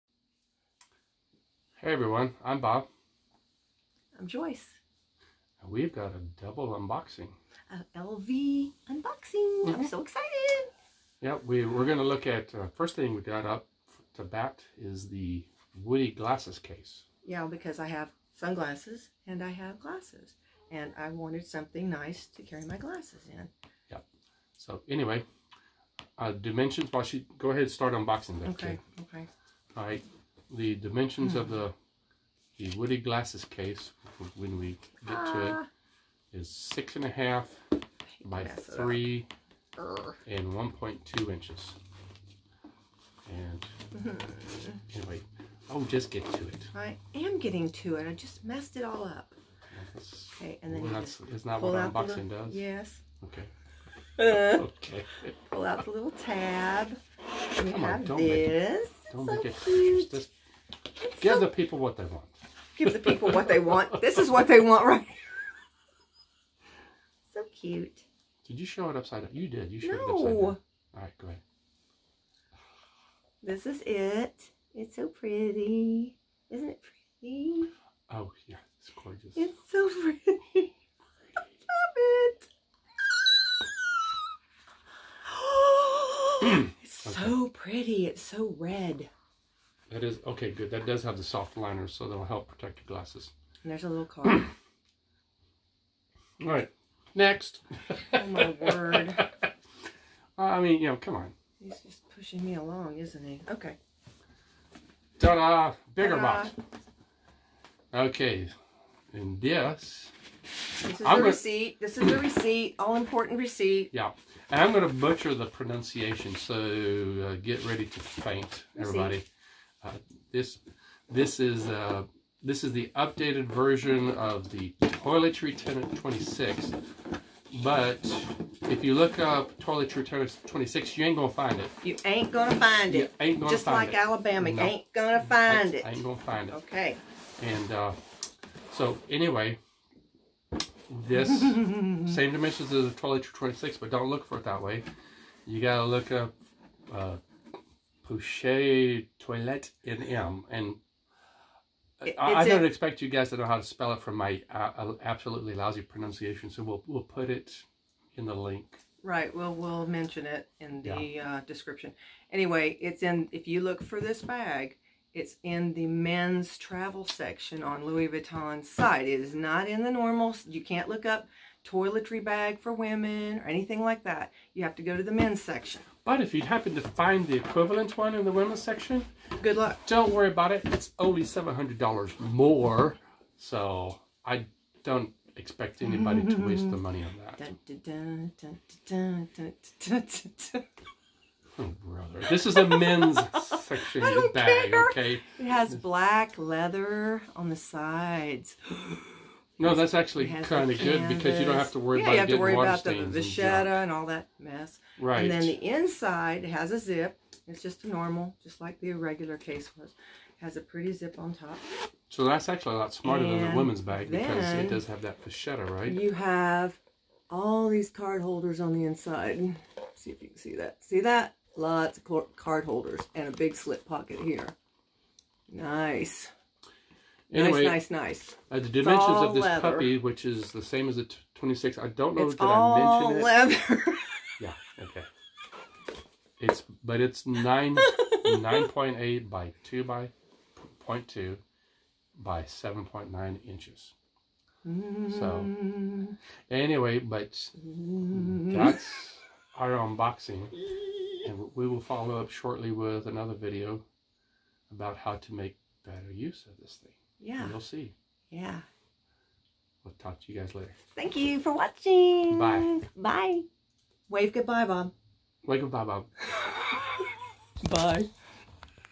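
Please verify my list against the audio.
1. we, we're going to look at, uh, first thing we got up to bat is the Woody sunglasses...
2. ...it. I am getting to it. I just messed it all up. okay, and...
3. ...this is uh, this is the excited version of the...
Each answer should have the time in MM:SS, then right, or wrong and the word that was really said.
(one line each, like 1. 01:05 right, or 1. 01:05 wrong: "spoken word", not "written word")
1. 00:11 wrong: "glasses", not "sunglasses"
2. 00:46 right
3. 02:01 wrong: "updated", not "excited".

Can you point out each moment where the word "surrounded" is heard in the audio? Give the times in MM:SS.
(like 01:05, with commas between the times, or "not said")
not said.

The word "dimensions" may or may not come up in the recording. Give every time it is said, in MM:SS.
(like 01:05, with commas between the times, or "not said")
00:26, 00:30, 02:22, 03:48.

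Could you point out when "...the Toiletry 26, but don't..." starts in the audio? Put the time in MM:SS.
02:22.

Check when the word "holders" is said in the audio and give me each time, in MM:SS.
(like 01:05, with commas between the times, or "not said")
03:38, 03:42.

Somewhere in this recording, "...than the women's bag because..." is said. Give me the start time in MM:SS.
03:33.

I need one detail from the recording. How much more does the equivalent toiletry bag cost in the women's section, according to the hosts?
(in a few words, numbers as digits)
$700.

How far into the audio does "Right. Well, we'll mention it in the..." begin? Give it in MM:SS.
02:39.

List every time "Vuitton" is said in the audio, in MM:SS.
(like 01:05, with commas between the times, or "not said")
02:48.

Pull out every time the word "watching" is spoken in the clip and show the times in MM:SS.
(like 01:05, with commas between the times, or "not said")
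04:21.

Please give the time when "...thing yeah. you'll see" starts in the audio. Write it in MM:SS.
04:16.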